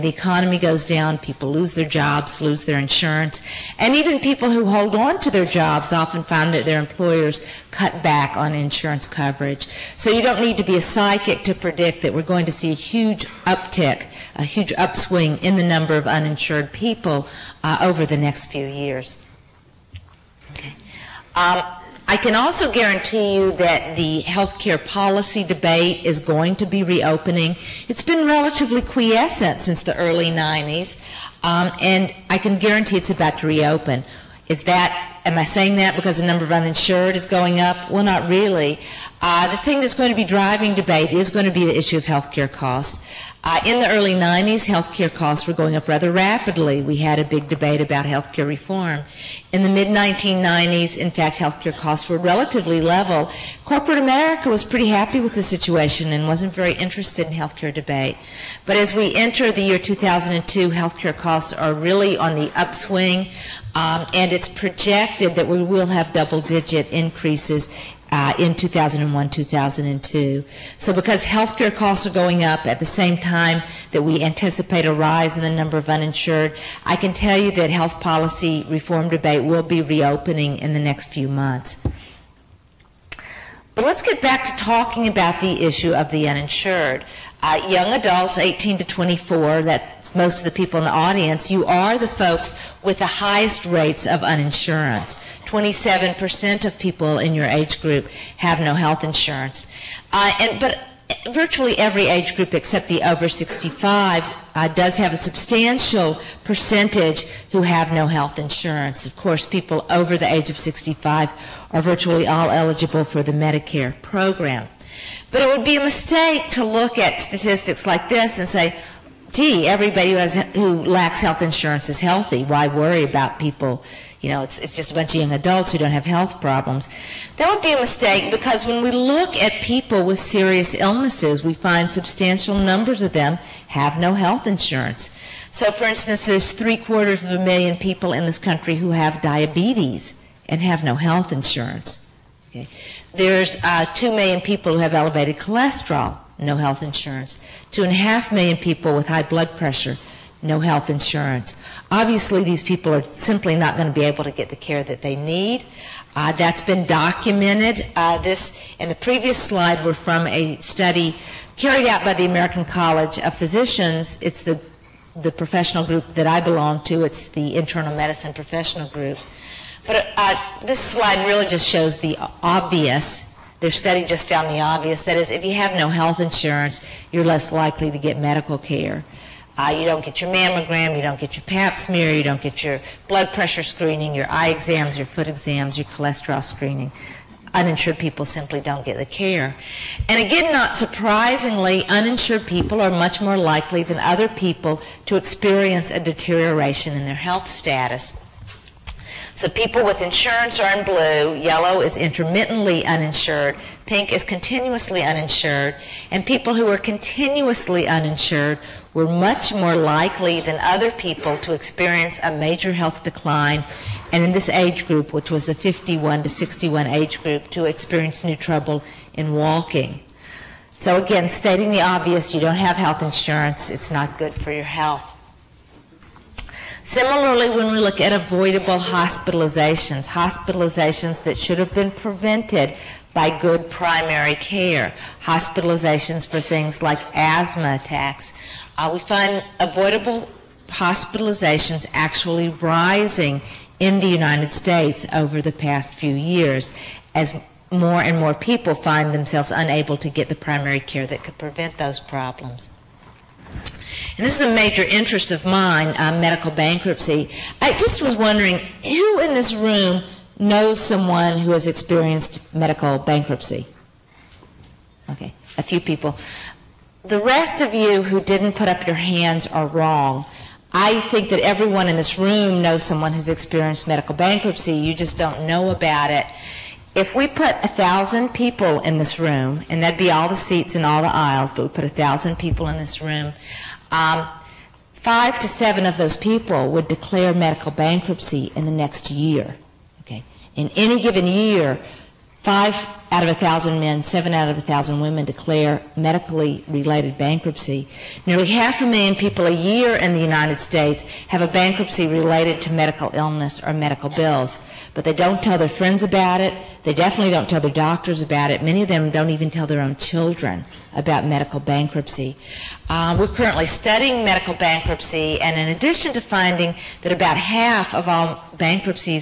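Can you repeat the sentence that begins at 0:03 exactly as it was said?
And even people who hold on to their jobs often find that their employers cut back on insurance coverage.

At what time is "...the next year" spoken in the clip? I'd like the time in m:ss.
4:48.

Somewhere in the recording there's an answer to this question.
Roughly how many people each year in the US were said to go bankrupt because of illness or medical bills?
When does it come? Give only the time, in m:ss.
4:58.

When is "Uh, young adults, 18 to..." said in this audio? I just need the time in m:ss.
1:27.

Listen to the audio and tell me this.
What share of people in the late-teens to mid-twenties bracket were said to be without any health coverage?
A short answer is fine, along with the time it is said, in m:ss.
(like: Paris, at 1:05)
27%, at 1:35.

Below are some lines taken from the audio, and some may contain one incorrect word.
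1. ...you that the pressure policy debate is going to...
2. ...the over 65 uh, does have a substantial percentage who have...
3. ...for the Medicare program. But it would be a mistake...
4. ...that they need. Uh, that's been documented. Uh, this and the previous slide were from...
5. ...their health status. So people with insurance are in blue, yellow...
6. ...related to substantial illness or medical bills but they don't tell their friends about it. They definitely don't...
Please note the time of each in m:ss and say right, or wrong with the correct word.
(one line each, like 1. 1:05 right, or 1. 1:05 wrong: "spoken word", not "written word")
1. 0:23 wrong: "healthcare", not "pressure"
2. 1:42 right
3. 1:53 right
4. 2:34 right
5. 3:17 right
6. 5:02 wrong: "medical", not "substantial".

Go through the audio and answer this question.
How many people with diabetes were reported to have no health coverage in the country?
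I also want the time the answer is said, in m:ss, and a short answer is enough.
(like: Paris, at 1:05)
three quarters of a million, at 2:16.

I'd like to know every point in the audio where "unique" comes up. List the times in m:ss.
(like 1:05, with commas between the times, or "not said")
not said.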